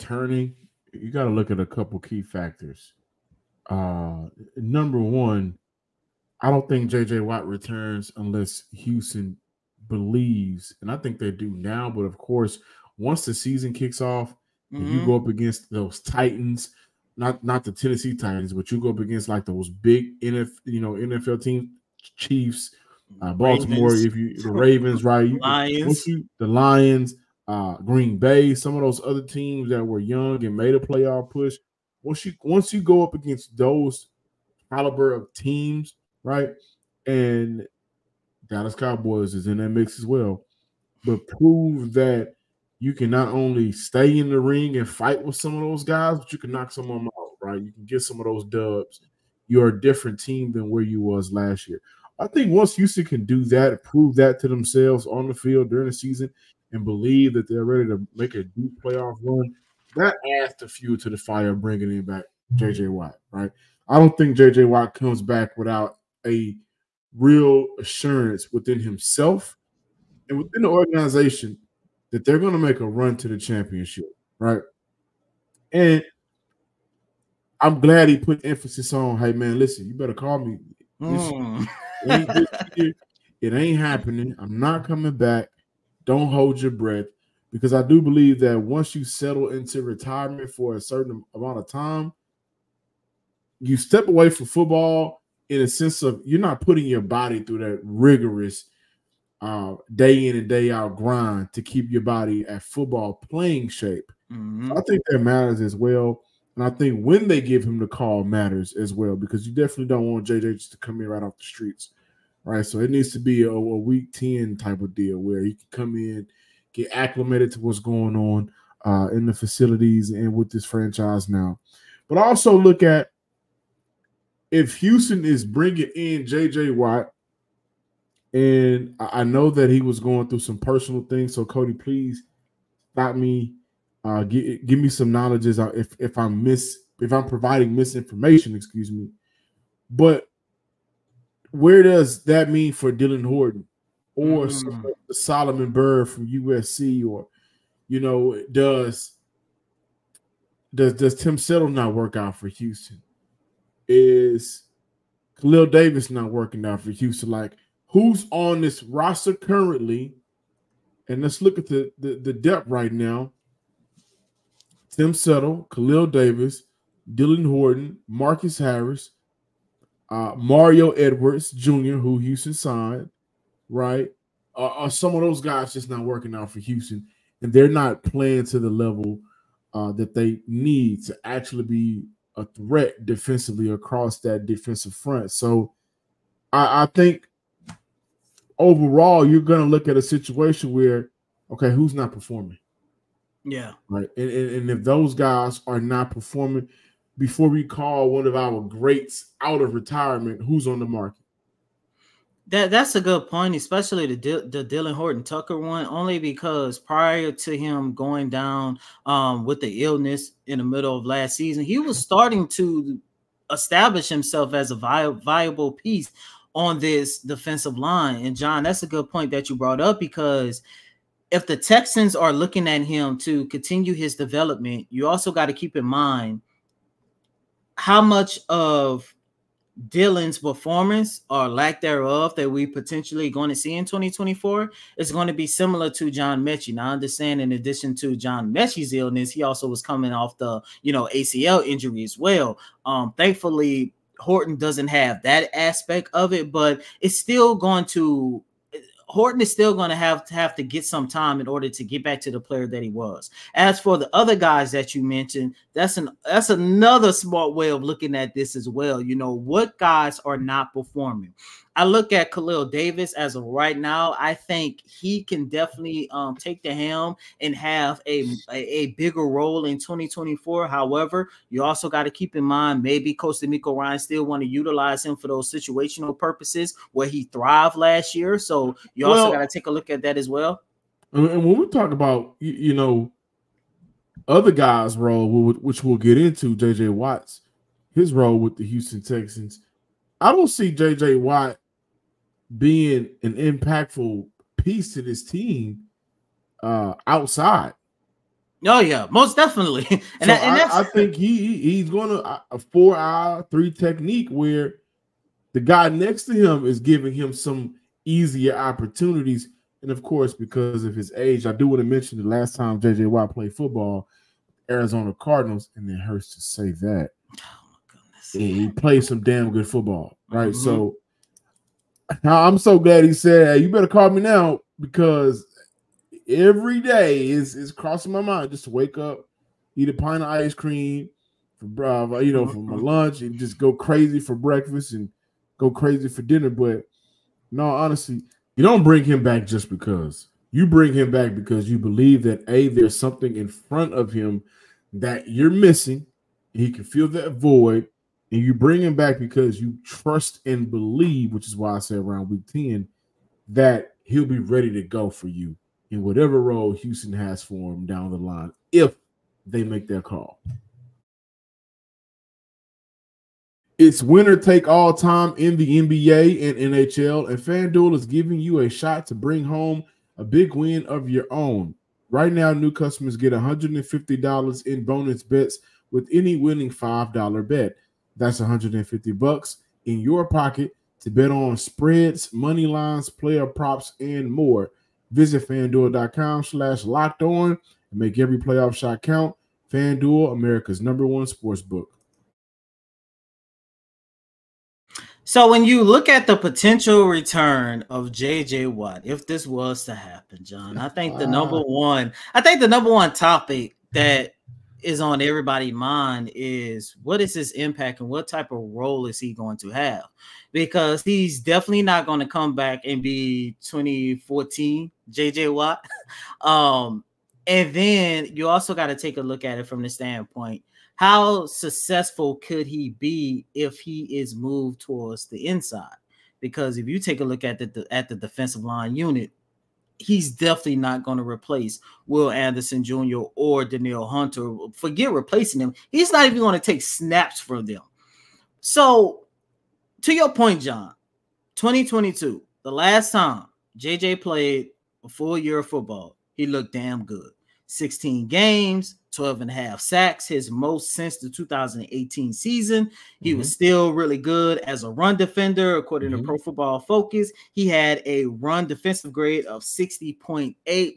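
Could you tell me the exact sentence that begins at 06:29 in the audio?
FanDuel, America's number one sports book.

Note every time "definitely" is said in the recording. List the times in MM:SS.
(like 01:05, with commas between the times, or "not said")
01:49, 04:25, 04:59, 06:51, 07:10.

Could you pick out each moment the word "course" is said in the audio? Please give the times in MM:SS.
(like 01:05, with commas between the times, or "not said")
00:12, 05:10.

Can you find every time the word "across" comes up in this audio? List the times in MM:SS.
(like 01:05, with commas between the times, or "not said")
03:03.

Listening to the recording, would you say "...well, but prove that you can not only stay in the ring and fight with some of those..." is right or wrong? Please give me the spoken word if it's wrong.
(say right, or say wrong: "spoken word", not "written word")
right.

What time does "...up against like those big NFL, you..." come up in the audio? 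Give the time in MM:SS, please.
00:18.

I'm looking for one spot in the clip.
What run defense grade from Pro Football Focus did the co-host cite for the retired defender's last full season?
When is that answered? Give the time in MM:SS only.
07:39.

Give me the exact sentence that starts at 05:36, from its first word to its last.
But no, honestly, you don't bring him back just because.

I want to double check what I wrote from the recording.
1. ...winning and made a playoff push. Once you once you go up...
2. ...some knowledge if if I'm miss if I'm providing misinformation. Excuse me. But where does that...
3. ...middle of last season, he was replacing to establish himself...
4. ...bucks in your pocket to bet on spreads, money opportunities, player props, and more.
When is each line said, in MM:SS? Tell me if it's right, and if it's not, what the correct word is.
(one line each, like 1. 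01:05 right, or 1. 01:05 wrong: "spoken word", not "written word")
1. 00:29 wrong: "young", not "winning"
2. 02:14 right
3. 03:30 wrong: "starting", not "replacing"
4. 06:19 wrong: "lines", not "opportunities".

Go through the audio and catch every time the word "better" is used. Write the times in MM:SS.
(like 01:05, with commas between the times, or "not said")
01:19, 05:23.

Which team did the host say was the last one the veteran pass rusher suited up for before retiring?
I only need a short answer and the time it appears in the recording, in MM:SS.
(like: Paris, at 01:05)
Arizona Cardinals, at 05:14.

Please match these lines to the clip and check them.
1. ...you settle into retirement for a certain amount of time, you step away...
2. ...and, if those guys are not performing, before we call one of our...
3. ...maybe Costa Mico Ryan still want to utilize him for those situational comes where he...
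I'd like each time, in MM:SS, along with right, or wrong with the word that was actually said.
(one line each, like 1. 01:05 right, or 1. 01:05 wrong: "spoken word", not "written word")
1. 01:28 right
2. 03:14 right
3. 04:32 wrong: "purposes", not "comes".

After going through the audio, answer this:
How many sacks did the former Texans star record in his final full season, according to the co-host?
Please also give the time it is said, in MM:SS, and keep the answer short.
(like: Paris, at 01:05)
12.5, at 07:29.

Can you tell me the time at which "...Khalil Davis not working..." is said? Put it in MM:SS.
02:35.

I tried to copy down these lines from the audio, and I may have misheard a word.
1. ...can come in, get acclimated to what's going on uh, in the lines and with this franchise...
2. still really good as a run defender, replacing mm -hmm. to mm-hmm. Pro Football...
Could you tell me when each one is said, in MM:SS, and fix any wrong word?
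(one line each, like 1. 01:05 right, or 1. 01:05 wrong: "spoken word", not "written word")
1. 01:55 wrong: "facilities", not "lines"
2. 07:33 wrong: "according", not "replacing".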